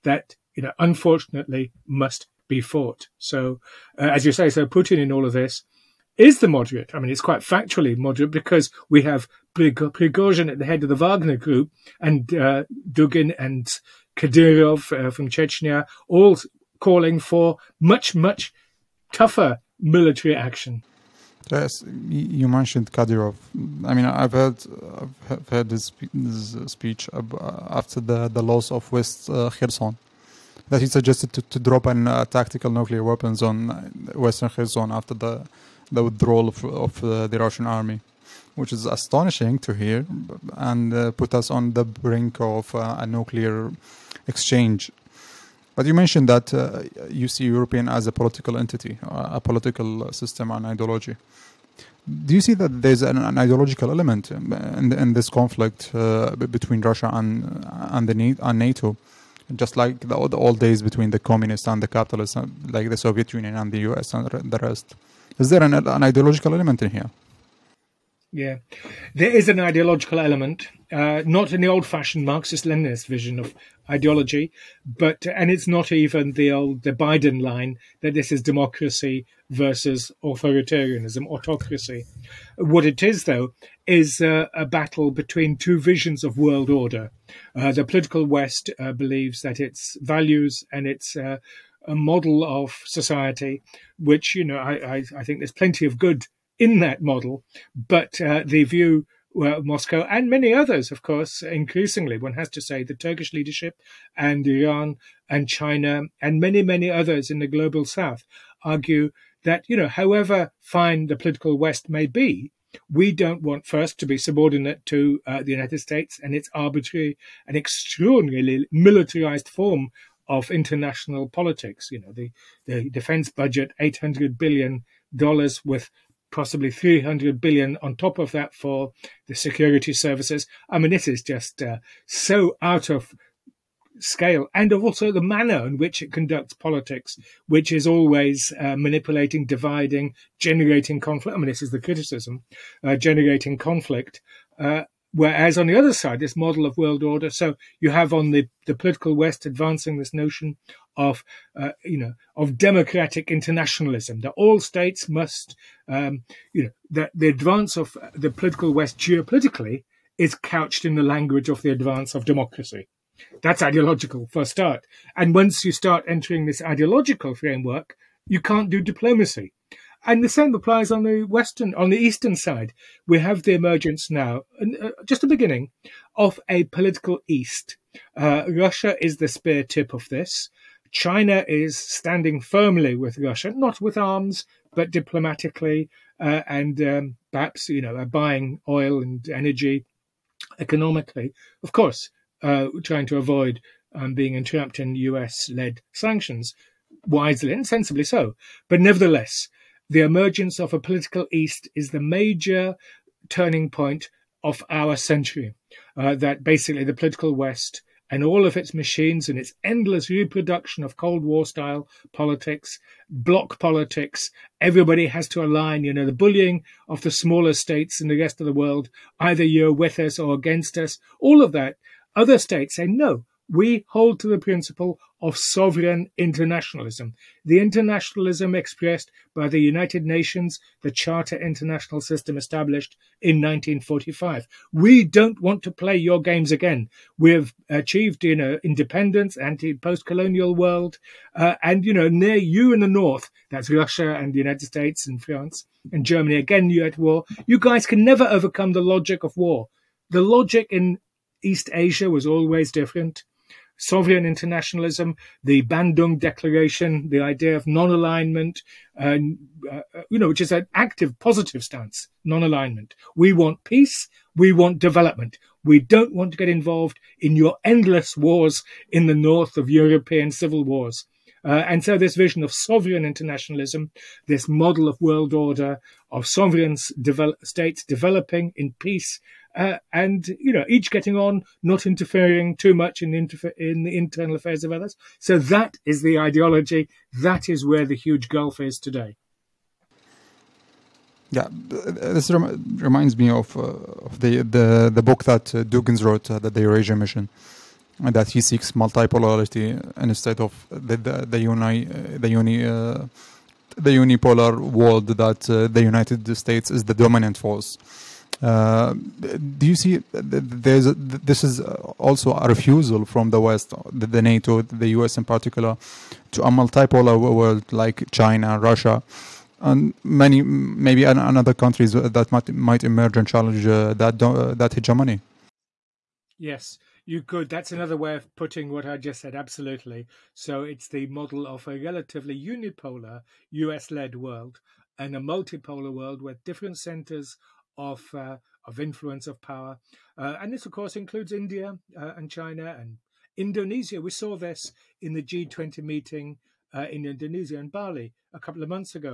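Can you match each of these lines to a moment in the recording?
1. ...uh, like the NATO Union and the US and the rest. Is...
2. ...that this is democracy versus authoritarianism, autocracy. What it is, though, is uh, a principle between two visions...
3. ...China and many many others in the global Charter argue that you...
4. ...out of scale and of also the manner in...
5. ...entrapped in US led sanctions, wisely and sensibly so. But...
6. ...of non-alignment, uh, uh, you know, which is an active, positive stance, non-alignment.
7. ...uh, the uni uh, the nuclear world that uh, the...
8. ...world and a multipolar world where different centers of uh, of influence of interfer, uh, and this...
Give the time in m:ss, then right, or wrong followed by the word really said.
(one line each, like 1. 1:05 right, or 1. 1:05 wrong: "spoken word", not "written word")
1. 1:02 wrong: "Soviet", not "NATO"
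2. 1:18 wrong: "battle", not "principle"
3. 1:45 wrong: "South", not "Charter"
4. 2:12 right
5. 3:14 right
6. 4:17 right
7. 5:01 wrong: "unipolar", not "nuclear"
8. 5:34 wrong: "power", not "interfer".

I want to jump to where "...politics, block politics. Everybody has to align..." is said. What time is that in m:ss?
3:32.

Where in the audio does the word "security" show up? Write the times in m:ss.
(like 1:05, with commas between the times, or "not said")
2:09.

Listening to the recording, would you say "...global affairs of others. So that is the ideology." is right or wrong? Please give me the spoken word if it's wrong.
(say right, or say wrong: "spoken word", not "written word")
wrong: "internal", not "global".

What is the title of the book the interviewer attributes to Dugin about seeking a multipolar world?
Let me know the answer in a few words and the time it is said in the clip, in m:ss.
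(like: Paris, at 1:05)
The Eurasia Mission, at 4:56.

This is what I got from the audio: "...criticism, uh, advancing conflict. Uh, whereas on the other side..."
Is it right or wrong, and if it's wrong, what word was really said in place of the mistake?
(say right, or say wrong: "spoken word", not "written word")
wrong: "generating", not "advancing".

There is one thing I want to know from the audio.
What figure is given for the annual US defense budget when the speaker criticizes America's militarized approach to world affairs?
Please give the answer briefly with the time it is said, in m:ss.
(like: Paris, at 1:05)
$800 billion, at 2:03.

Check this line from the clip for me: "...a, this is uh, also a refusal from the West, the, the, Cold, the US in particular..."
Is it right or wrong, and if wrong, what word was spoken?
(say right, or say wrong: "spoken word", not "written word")
wrong: "NATO", not "Cold".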